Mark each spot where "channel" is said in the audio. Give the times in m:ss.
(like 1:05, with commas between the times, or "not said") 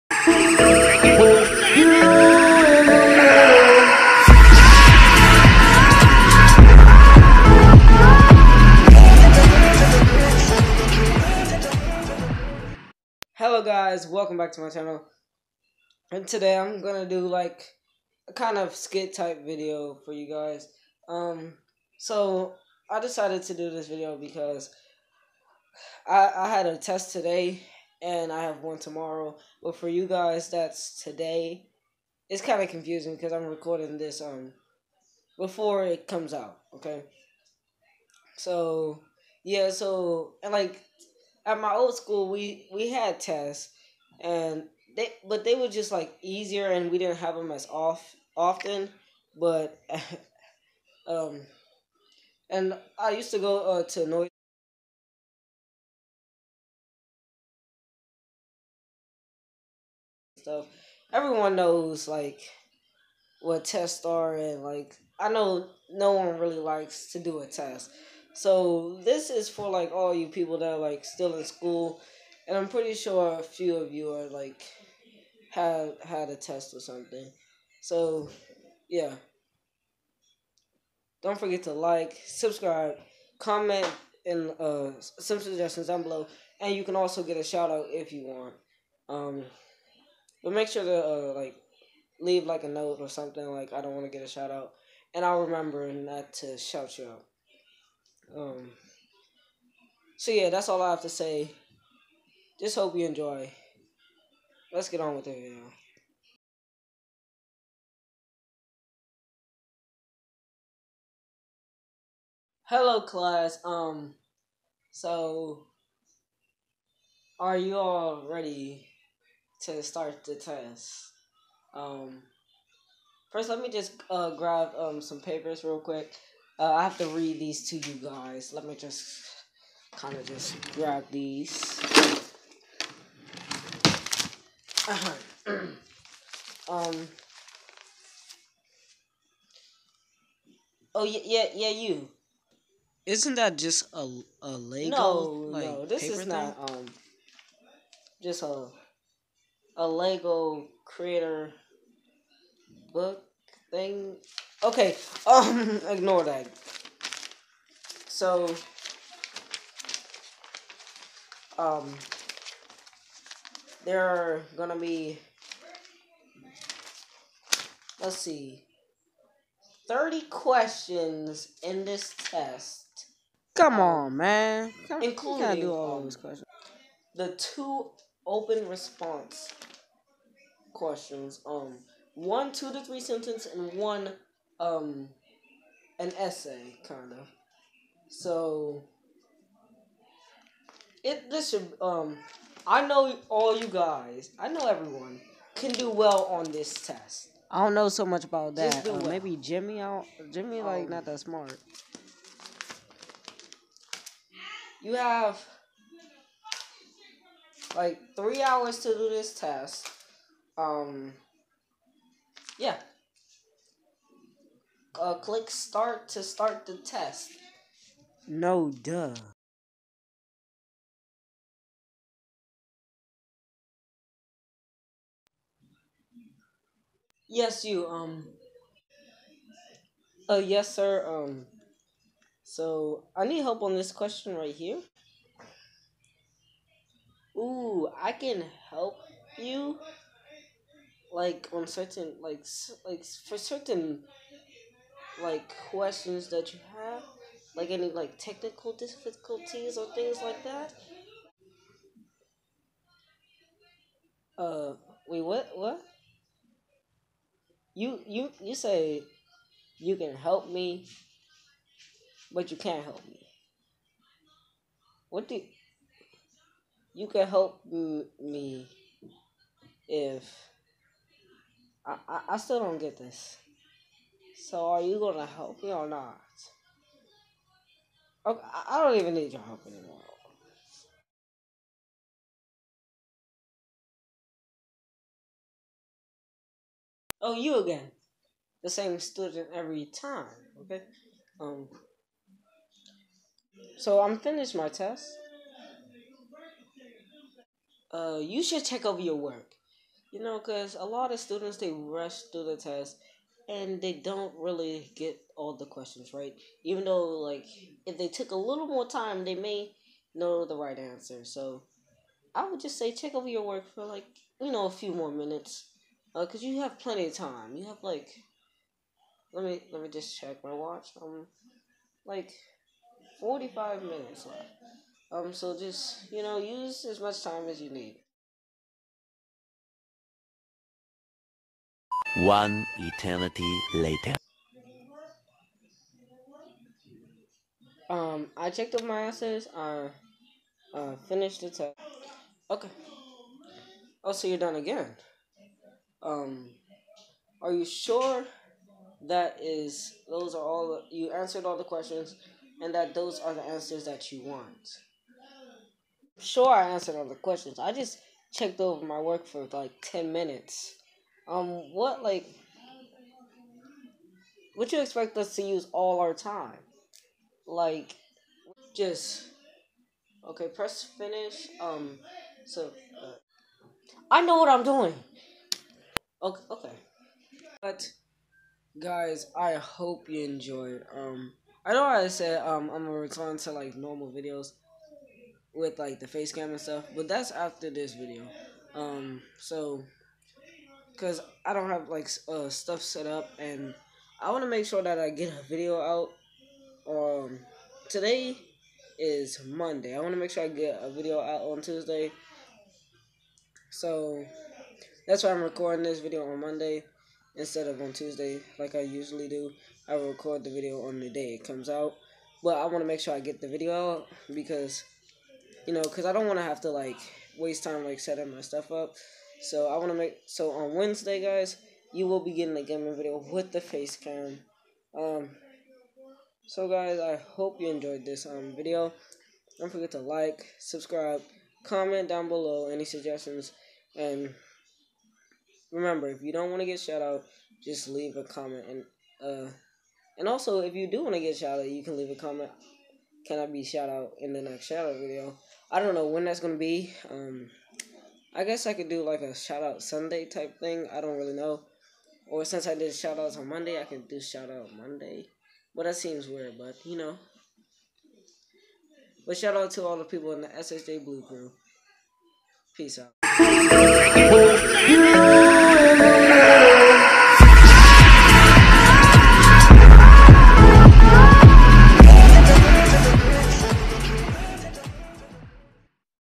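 0:14.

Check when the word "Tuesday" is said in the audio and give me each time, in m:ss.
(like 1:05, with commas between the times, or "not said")
6:41, 6:47.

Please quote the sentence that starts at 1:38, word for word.
Um, so yeah, that's all I have to say.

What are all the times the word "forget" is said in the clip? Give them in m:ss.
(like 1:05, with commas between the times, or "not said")
1:21, 7:09.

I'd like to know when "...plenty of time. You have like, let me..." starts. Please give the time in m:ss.
5:16.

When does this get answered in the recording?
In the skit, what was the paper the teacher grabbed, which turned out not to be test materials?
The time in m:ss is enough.
2:29.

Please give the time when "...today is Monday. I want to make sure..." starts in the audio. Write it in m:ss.
6:37.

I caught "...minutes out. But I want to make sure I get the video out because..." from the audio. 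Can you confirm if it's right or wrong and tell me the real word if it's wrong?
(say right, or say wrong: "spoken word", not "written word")
wrong: "comes", not "minutes".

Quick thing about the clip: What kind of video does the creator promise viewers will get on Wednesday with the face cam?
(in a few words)
gaming video.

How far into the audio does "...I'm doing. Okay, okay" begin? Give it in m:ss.
6:14.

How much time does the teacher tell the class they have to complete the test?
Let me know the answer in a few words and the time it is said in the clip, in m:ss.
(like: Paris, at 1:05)
3 hours, at 3:28.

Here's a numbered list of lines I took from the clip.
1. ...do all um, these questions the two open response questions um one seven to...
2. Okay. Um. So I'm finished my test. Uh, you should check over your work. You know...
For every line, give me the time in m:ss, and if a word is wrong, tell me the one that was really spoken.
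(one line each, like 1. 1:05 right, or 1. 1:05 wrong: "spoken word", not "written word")
1. 2:55 wrong: "two", not "seven"
2. 4:50 right.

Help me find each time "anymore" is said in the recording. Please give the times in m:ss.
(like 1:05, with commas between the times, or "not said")
4:39.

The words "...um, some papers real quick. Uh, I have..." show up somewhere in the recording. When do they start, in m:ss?
2:04.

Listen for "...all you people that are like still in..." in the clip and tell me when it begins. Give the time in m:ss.
1:09.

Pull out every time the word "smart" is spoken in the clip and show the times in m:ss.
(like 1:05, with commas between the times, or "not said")
3:21.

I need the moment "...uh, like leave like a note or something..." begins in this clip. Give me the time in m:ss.
1:31.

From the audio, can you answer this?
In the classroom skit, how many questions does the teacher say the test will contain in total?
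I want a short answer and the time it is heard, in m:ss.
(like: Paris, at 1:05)
30, at 2:49.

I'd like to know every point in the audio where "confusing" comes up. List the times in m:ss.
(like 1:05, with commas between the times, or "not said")
0:32.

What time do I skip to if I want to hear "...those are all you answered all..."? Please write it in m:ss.
5:50.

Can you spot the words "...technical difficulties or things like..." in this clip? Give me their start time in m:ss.
4:08.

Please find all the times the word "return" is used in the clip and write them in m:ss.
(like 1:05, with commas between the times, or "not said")
6:22.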